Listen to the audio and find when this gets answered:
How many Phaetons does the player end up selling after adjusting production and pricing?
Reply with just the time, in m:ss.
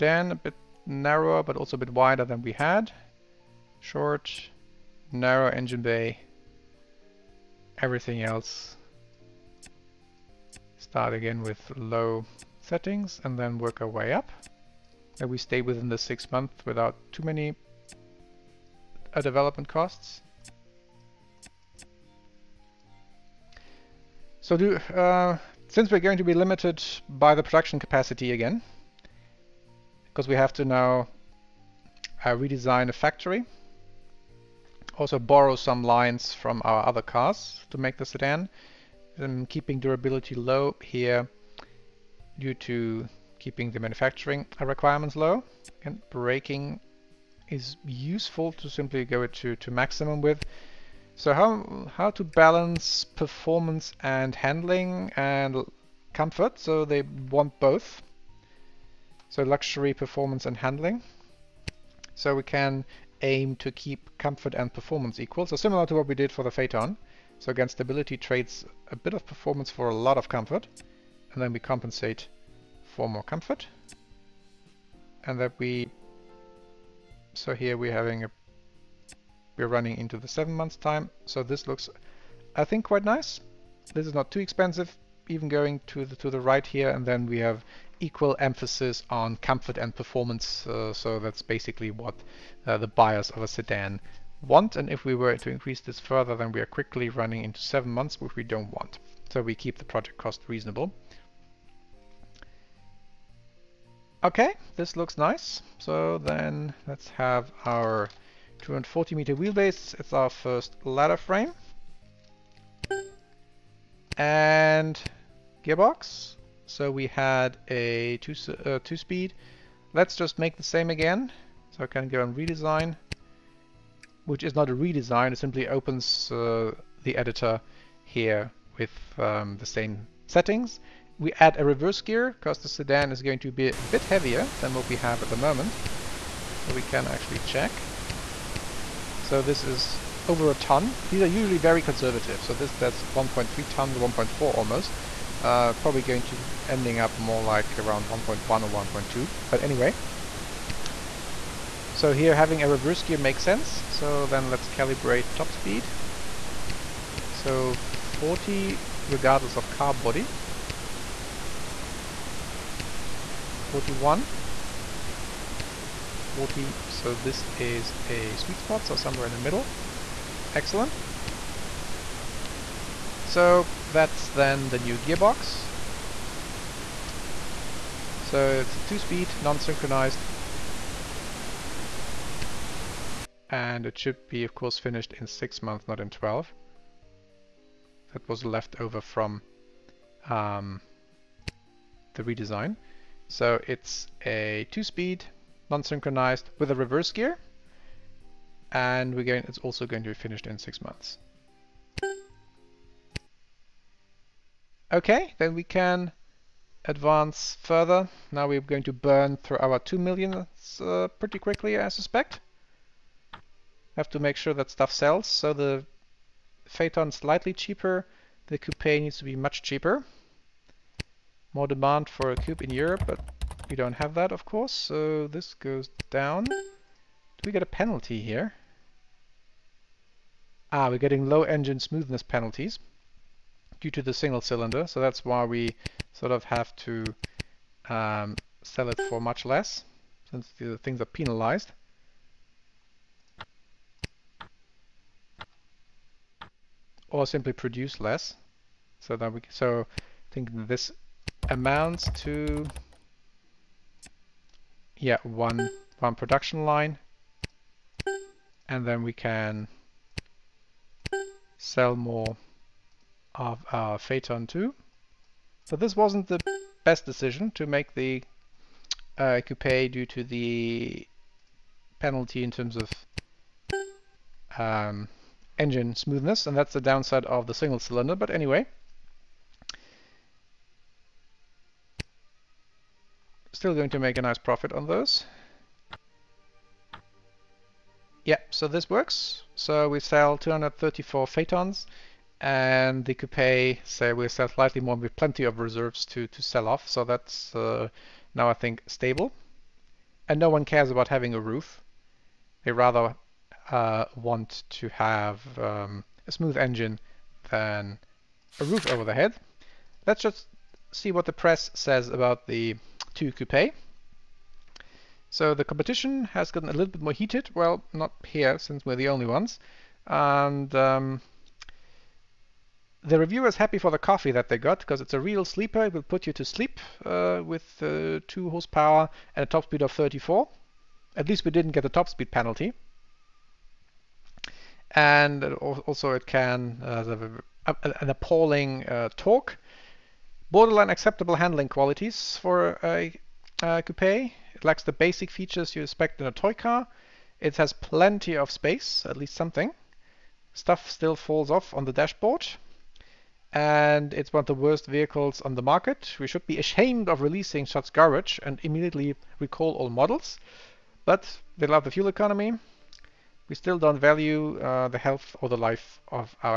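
4:50.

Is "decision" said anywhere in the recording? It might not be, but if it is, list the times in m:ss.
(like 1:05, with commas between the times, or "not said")
4:27.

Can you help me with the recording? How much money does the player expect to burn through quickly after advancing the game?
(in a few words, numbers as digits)
2 million.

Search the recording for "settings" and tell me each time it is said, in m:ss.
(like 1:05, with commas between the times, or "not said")
0:12, 2:10.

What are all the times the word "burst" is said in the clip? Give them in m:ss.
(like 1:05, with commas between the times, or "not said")
not said.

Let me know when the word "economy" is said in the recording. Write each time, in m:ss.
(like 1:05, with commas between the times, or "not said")
6:02.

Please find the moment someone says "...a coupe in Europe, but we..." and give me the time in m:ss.
3:42.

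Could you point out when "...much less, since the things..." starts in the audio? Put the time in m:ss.
3:59.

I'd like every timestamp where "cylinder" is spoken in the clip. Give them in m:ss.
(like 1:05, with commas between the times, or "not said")
3:54, 4:37.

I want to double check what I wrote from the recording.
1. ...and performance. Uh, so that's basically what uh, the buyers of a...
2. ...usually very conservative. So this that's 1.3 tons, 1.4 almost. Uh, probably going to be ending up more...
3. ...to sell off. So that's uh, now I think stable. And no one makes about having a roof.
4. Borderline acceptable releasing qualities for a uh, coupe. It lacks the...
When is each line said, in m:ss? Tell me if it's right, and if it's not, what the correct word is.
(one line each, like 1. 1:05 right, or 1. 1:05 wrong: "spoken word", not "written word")
1. 1:29 right
2. 2:21 right
3. 4:56 wrong: "cares", not "makes"
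4. 5:40 wrong: "handling", not "releasing".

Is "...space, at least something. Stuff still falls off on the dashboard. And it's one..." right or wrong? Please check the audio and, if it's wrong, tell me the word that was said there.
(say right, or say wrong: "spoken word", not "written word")
right.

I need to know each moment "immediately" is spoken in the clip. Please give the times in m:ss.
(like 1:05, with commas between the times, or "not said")
5:58.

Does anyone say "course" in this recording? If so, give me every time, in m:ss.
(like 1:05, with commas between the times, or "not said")
3:04, 3:44.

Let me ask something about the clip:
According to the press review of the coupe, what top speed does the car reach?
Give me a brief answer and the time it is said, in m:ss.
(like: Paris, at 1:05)
34, at 5:29.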